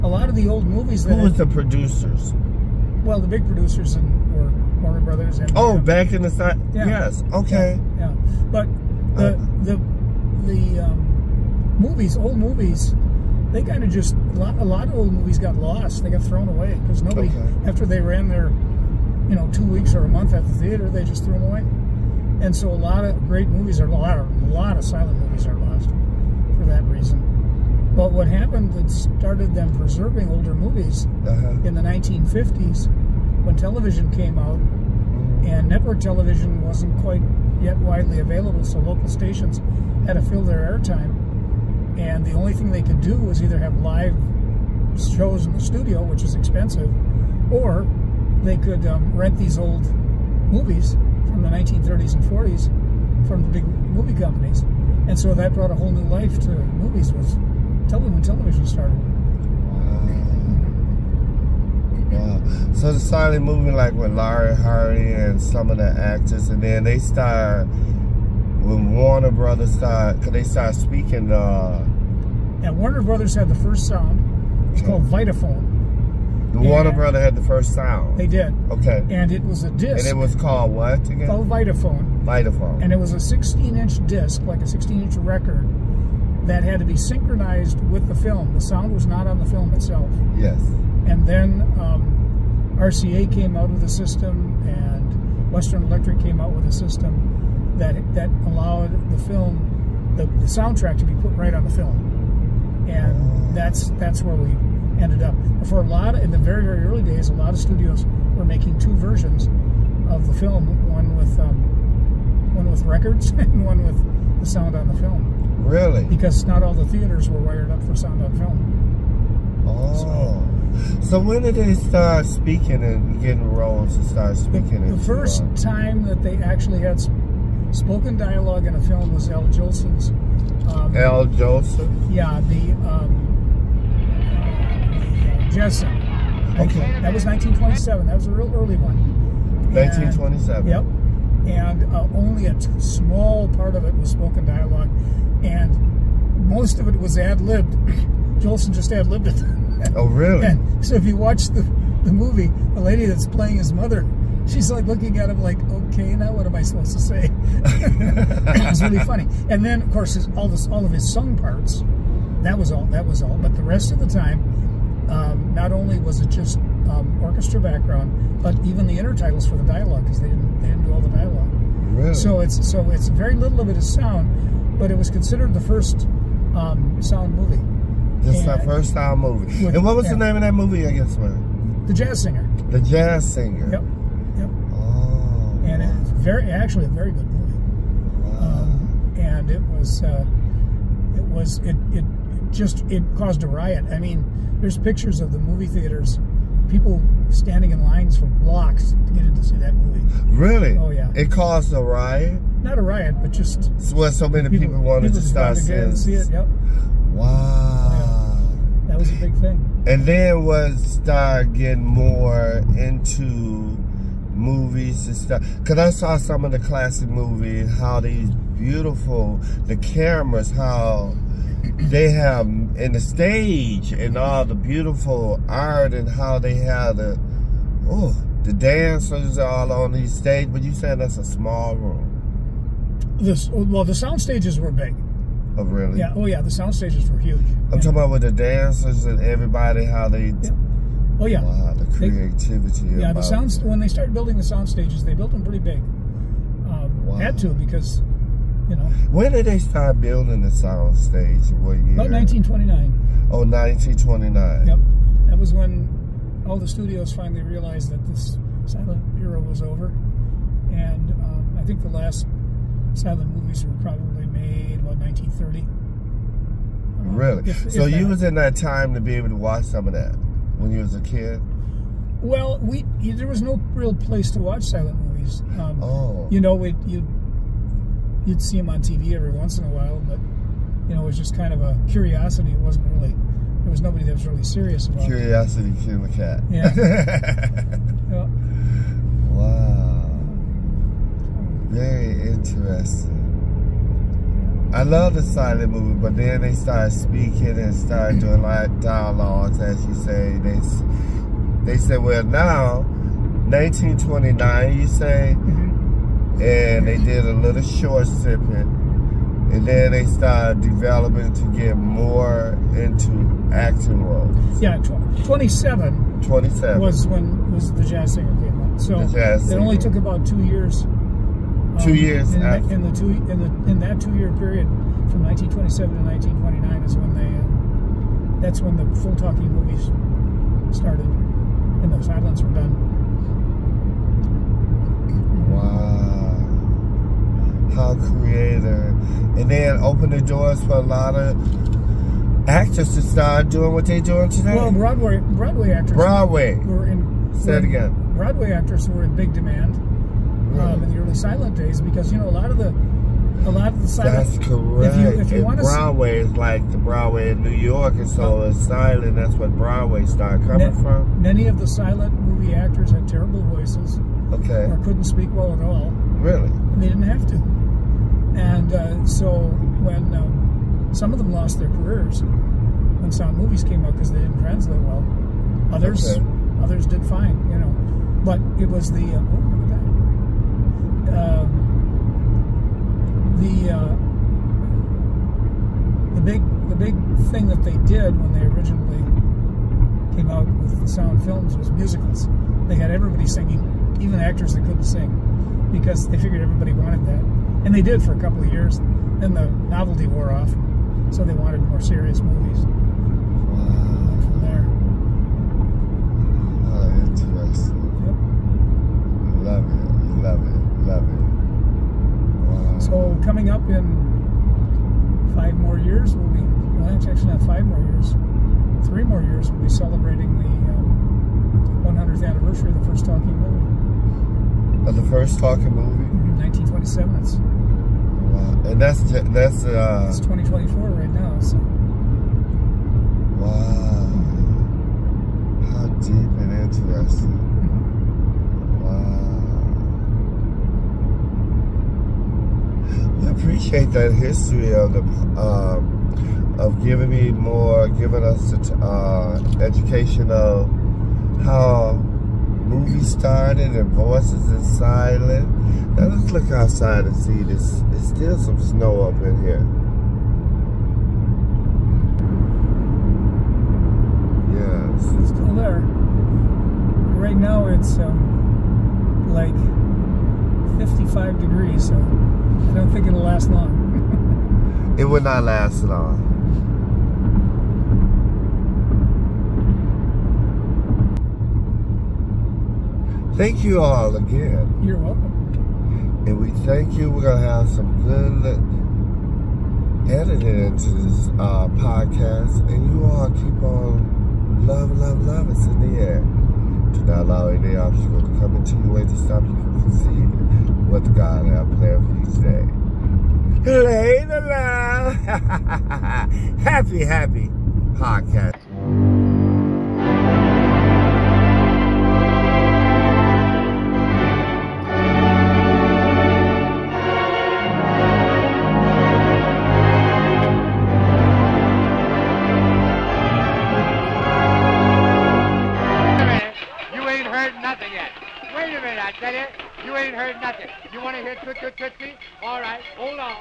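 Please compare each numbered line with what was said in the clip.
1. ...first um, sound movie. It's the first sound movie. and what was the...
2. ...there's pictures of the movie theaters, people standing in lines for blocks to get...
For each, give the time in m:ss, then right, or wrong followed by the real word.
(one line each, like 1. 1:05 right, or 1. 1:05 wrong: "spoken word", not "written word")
1. 2:55 right
2. 3:14 right.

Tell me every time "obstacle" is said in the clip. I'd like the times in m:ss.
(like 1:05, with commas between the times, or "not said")
8:17.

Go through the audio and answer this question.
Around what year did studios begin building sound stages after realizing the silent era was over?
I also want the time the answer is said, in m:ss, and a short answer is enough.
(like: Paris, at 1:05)
1929, at 4:11.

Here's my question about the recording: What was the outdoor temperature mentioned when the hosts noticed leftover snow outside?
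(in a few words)
55 degrees.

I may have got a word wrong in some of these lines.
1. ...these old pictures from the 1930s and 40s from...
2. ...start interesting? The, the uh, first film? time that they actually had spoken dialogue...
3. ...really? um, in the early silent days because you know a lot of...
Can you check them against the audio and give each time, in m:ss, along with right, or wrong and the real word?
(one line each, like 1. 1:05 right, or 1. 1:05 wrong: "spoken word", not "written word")
1. 0:49 wrong: "movies", not "pictures"
2. 2:04 wrong: "speaking", not "interesting"
3. 5:50 right.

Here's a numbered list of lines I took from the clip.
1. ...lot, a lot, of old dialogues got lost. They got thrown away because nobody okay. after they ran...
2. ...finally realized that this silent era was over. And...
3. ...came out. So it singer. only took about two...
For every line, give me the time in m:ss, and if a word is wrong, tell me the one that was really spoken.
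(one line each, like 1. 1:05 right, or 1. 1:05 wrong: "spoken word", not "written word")
1. 0:14 wrong: "movies", not "dialogues"
2. 4:17 right
3. 5:18 right.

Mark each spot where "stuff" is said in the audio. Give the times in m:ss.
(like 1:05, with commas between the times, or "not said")
3:35.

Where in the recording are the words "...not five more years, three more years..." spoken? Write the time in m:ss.
6:57.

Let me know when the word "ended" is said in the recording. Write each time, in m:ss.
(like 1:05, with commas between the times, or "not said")
1:45.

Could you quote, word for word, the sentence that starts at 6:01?
Many of the silent movie actors had terrible voices.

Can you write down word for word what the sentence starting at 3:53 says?
This well, the sound stages were big.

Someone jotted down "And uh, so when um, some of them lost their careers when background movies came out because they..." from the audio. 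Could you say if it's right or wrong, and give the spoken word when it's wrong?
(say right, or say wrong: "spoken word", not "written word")
wrong: "sound", not "background".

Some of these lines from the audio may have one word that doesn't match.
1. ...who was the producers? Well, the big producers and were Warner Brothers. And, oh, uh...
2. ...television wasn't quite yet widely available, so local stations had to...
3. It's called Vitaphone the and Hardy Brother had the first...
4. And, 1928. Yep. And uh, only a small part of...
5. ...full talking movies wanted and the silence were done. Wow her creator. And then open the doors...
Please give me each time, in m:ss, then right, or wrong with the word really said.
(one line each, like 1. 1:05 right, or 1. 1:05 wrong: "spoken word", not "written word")
1. 0:01 right
2. 0:35 right
3. 1:14 wrong: "Warner", not "Hardy"
4. 2:19 wrong: "1927", not "1928"
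5. 5:29 wrong: "started", not "wanted".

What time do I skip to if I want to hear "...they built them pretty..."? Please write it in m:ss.
4:05.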